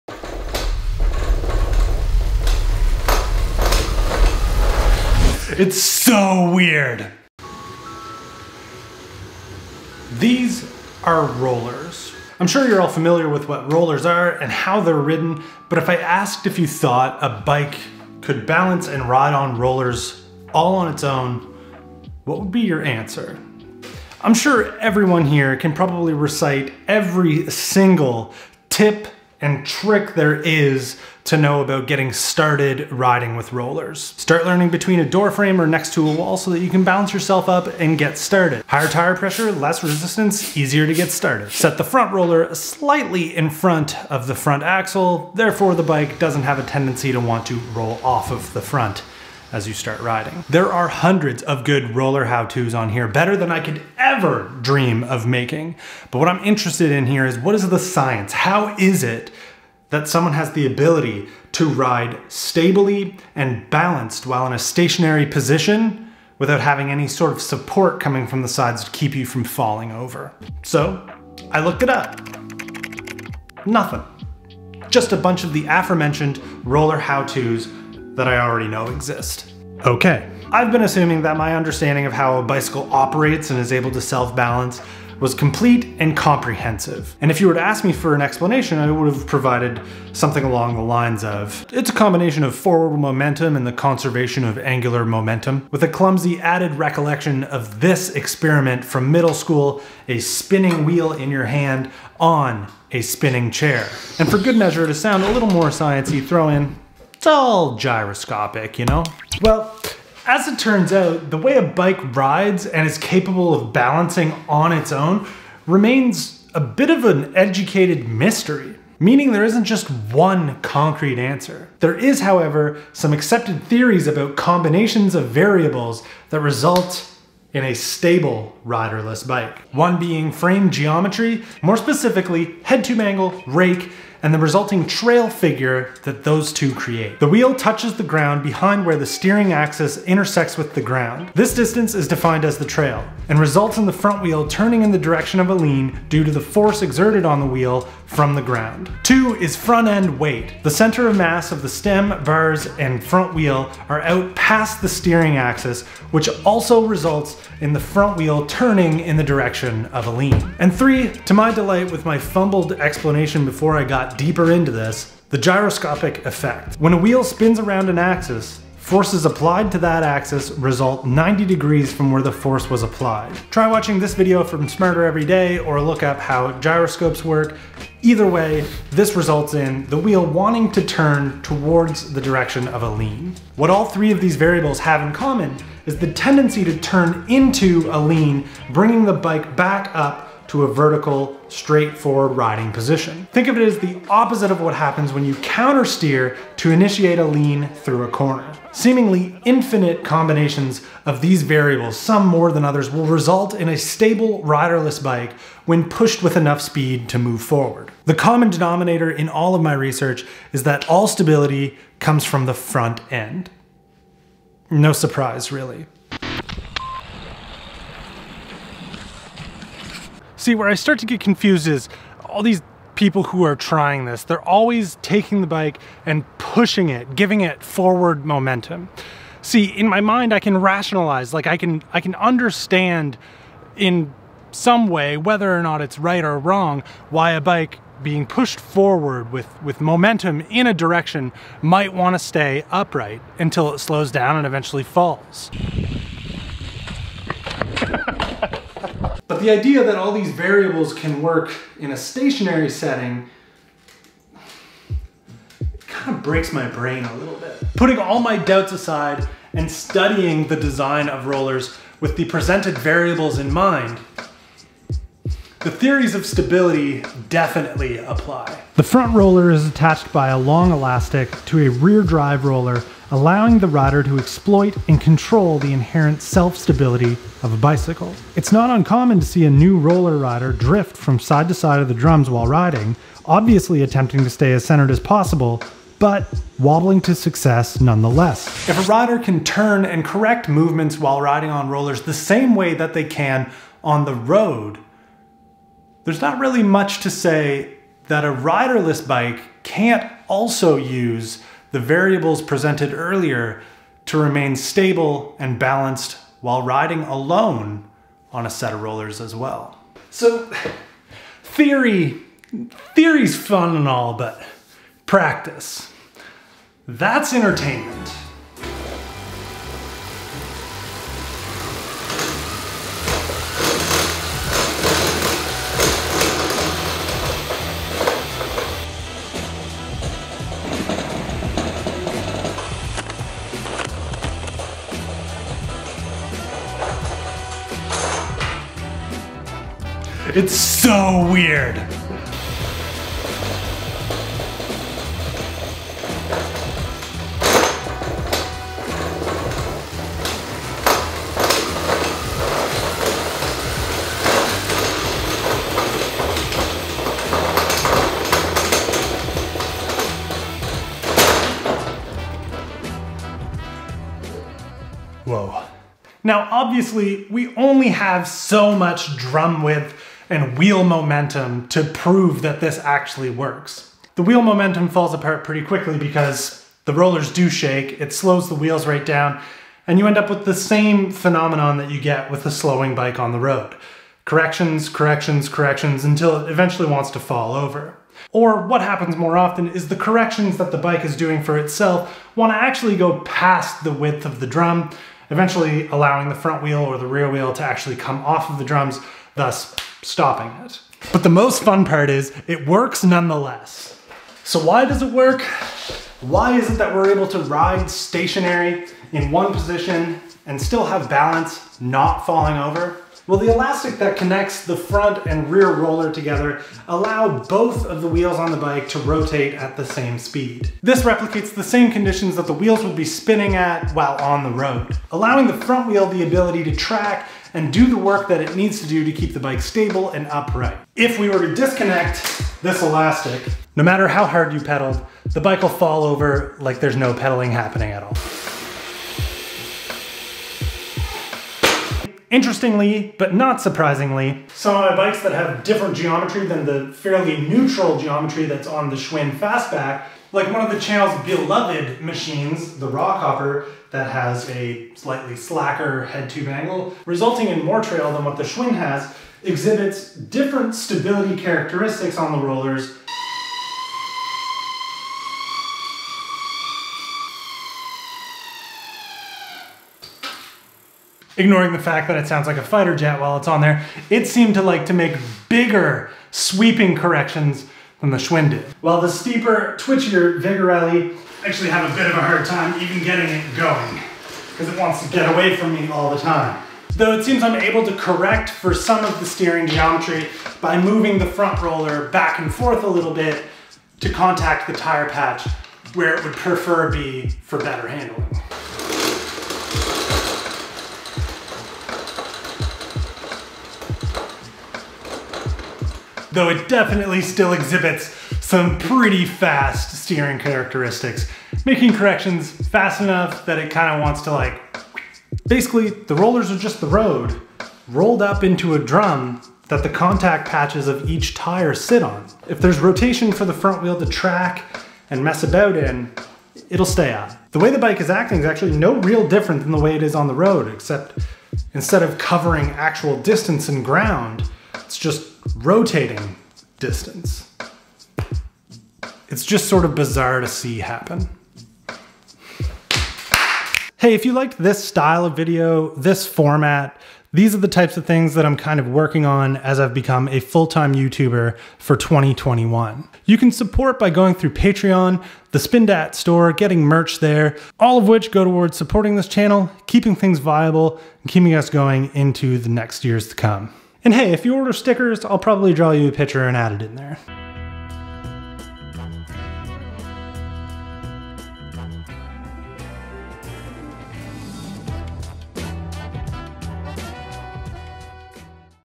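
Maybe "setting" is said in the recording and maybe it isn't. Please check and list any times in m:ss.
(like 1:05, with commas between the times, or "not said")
4:12.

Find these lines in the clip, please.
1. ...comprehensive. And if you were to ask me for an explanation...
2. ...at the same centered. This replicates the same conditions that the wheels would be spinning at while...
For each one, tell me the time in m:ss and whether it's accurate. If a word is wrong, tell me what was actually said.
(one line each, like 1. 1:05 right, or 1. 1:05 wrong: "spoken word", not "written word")
1. 1:26 right
2. 6:59 wrong: "speed", not "centered".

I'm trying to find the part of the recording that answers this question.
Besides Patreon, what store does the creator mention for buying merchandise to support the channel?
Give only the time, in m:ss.
9:15.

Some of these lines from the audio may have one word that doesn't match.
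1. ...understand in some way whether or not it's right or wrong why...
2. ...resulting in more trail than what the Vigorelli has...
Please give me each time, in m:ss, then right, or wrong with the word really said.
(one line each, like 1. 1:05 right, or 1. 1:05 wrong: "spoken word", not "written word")
1. 3:52 right
2. 7:37 wrong: "Schwinn", not "Vigorelli".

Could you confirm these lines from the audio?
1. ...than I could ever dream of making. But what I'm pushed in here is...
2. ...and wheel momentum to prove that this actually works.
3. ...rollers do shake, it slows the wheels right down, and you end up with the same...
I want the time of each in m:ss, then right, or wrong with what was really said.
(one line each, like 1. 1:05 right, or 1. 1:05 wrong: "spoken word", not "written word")
1. 0:53 wrong: "interested", not "pushed"
2. 6:10 right
3. 6:16 right.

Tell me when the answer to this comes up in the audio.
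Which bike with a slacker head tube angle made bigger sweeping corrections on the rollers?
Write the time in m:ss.
7:32.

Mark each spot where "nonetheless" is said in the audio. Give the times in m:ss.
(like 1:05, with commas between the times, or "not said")
4:47, 6:43.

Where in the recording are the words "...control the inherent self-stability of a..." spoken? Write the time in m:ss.
4:35.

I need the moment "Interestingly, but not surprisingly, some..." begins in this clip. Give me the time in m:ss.
7:22.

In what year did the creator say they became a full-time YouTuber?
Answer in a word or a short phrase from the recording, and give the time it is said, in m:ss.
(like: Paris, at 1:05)
2021, at 9:11.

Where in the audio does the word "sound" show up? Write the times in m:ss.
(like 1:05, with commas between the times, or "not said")
1:44, 7:52.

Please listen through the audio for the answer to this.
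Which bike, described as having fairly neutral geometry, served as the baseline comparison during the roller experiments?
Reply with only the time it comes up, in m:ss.
7:28.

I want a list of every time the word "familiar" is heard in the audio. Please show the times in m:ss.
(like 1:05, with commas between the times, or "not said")
0:12.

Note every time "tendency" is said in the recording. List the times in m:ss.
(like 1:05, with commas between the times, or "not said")
0:46, 3:06.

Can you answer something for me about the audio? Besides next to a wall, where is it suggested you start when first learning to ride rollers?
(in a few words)
a door frame.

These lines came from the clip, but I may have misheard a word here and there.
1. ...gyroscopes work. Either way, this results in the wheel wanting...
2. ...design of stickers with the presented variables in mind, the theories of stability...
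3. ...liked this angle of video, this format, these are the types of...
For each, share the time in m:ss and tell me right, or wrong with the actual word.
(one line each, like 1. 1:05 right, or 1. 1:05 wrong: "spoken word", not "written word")
1. 2:56 right
2. 4:20 wrong: "rollers", not "stickers"
3. 9:04 wrong: "style", not "angle".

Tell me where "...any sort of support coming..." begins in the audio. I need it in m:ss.
1:06.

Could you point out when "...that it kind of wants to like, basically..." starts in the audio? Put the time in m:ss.
8:33.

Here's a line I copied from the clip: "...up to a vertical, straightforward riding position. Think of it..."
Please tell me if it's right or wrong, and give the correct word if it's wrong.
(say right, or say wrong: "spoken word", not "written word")
right.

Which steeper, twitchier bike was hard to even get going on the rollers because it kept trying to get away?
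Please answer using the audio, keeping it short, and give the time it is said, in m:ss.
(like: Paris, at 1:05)
Vigorelli, at 8:00.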